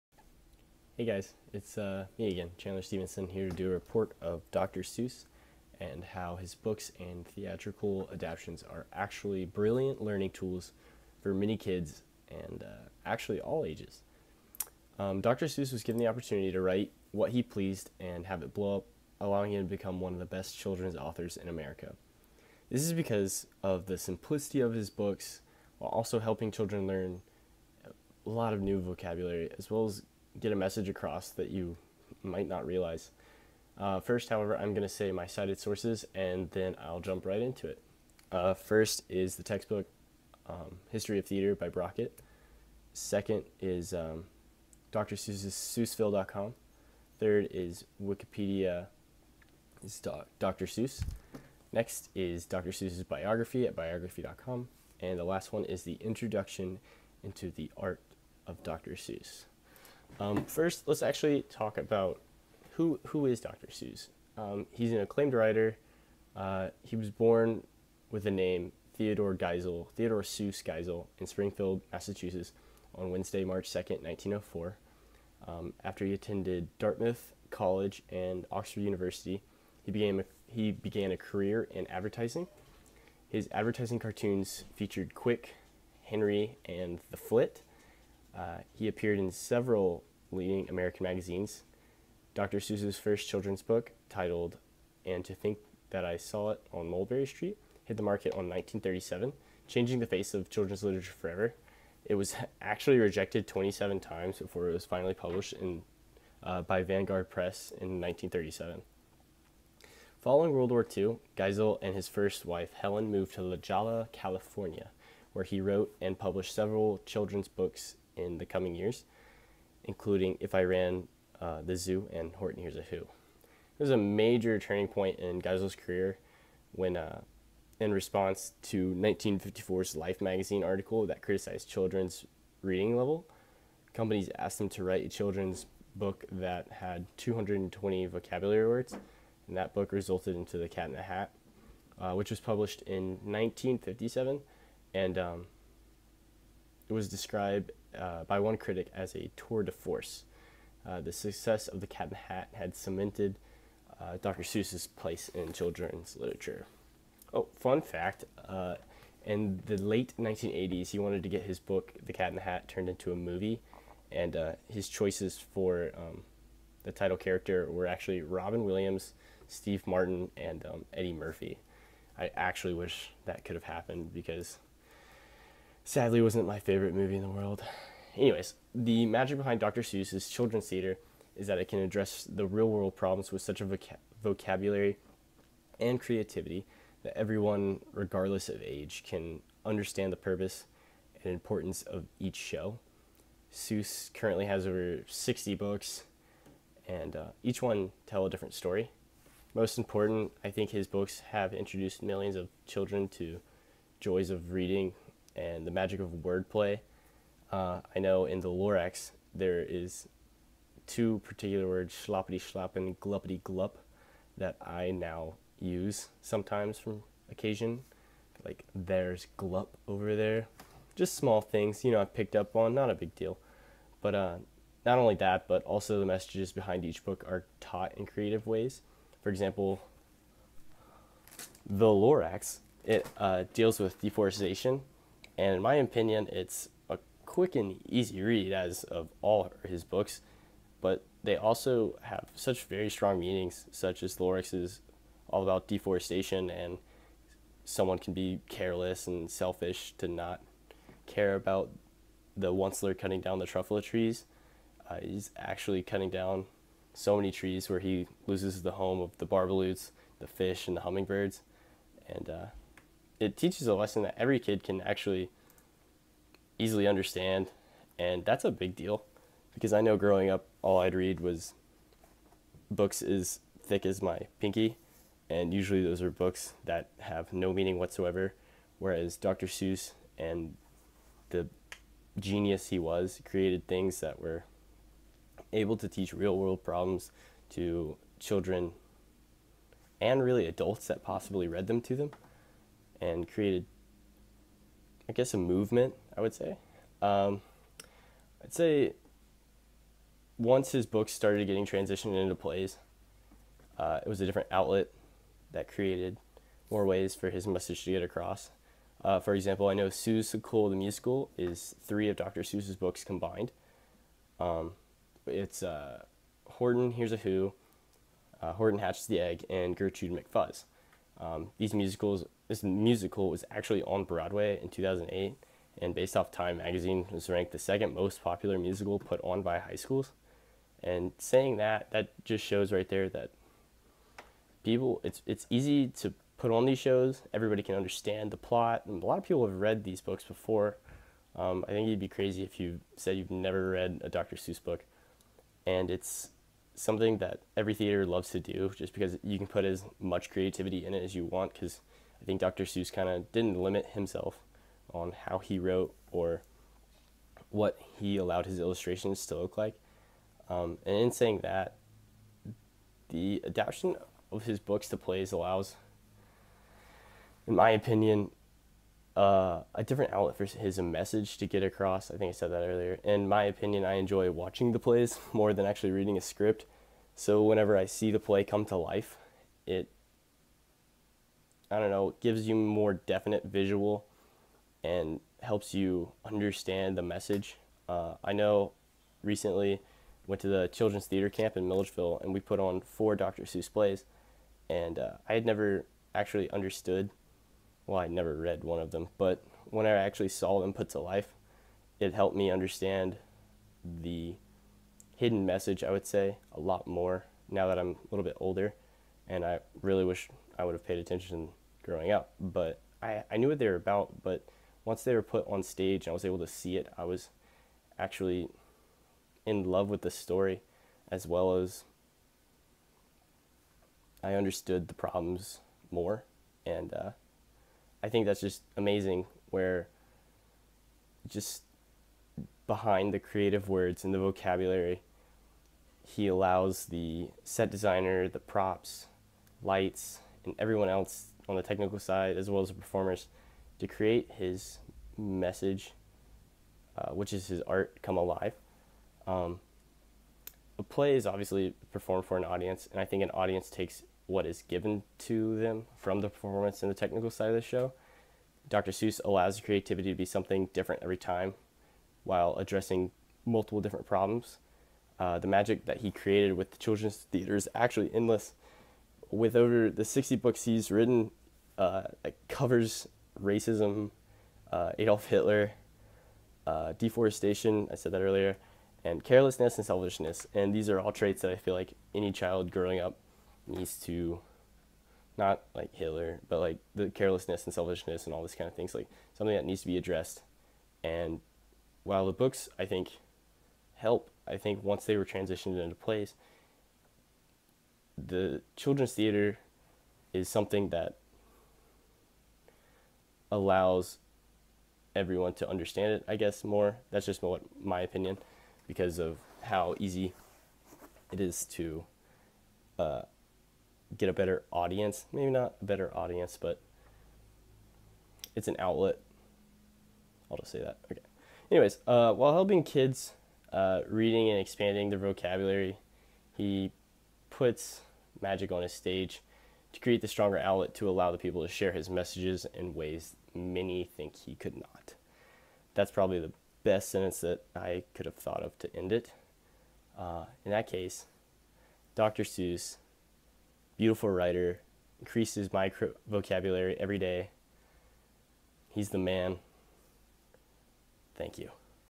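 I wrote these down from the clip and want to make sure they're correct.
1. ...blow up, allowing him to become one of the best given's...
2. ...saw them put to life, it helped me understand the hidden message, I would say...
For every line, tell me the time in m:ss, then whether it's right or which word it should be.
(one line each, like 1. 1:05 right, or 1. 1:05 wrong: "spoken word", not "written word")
1. 0:18 wrong: "children", not "given"
2. 6:40 right.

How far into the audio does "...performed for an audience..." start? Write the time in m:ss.
7:31.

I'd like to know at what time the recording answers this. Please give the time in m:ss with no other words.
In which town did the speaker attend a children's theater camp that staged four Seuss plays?
6:31.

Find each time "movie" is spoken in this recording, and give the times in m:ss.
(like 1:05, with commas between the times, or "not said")
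2:43, 2:56.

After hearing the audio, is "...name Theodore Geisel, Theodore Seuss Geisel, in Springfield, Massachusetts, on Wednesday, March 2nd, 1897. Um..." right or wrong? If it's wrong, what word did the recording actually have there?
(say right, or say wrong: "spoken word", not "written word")
wrong: "1904", not "1897".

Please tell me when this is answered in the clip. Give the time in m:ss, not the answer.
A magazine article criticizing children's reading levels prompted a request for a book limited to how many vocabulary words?
2:17.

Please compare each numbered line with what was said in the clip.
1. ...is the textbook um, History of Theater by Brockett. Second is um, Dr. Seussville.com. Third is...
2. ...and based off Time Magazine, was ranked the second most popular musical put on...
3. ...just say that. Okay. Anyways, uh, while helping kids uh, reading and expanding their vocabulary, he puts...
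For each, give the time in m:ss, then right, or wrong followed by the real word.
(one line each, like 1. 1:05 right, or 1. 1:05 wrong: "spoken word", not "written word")
1. 0:39 right
2. 5:25 right
3. 8:40 right.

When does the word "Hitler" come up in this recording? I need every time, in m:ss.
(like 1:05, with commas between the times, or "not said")
7:55, 8:05.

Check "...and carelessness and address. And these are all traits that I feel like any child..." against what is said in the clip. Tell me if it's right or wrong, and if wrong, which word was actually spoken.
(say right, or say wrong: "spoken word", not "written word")
wrong: "selfishness", not "address".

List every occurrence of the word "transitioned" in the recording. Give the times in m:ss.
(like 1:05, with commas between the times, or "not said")
5:01, 8:15.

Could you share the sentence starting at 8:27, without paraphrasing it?
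That's just what my opinion, because of how easy it is to uh, get a better audience.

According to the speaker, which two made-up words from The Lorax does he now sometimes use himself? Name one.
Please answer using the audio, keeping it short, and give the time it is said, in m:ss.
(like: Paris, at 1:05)
gluppity glup, at 3:32.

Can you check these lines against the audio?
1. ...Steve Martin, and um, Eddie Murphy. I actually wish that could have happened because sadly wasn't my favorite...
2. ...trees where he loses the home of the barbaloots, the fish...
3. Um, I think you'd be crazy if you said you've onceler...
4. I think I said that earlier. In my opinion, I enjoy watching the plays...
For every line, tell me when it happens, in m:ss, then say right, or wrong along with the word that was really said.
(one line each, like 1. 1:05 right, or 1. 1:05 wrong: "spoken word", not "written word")
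1. 2:49 right
2. 4:17 right
3. 5:41 wrong: "never", not "onceler"
4. 6:12 right.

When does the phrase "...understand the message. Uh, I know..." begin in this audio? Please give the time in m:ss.
6:26.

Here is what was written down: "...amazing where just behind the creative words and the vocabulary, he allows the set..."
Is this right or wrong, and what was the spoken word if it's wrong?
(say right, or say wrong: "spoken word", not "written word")
right.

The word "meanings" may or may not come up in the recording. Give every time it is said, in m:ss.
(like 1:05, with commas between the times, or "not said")
4:03, 4:37.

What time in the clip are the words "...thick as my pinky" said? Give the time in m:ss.
4:33.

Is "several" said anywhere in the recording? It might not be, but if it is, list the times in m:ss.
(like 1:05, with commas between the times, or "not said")
1:29, 1:56.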